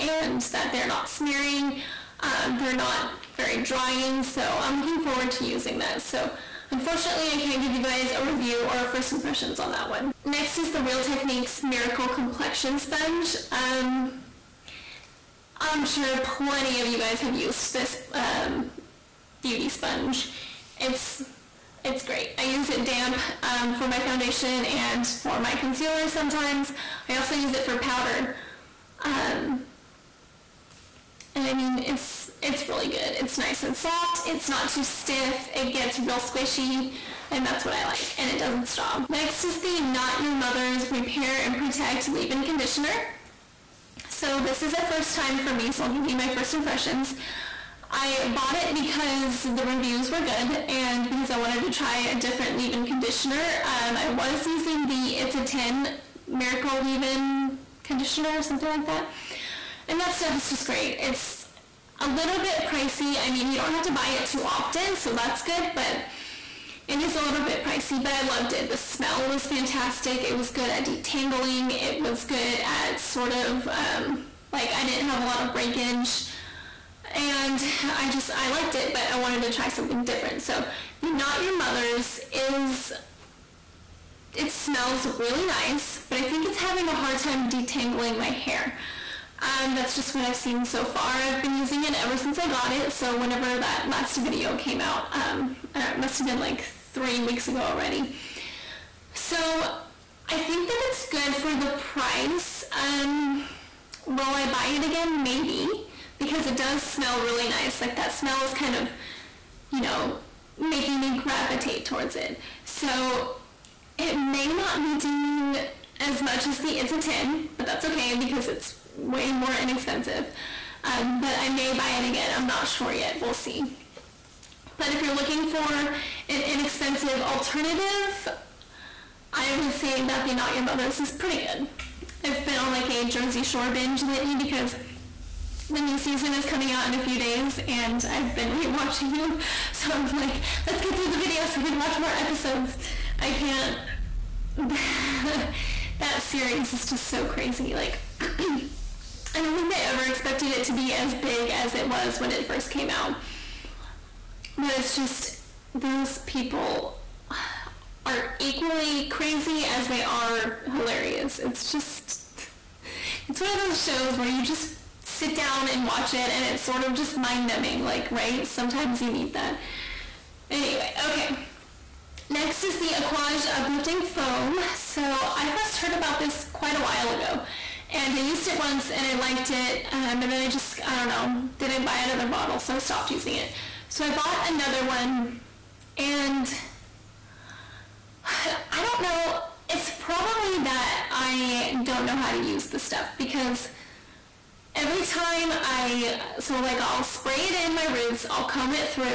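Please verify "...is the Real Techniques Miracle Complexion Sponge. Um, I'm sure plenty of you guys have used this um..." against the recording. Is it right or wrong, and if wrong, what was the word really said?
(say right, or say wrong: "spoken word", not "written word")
right.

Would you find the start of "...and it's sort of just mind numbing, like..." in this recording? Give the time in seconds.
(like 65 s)
166 s.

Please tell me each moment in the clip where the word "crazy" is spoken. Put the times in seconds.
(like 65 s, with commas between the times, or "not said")
147 s, 159 s.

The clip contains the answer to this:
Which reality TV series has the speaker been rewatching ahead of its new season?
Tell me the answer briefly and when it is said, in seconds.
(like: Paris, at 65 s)
Jersey Shore, at 133 s.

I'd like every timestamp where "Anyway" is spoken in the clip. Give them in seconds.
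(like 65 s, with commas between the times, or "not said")
170 s.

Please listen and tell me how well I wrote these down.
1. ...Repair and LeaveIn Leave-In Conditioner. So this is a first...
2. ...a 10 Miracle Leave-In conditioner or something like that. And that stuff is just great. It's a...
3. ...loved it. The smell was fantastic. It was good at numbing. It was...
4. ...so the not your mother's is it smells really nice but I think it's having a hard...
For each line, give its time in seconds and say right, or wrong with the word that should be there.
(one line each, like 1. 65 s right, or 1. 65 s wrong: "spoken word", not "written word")
1. 40 s wrong: "Protect", not "LeaveIn"
2. 55 s right
3. 68 s wrong: "detangling", not "numbing"
4. 80 s right.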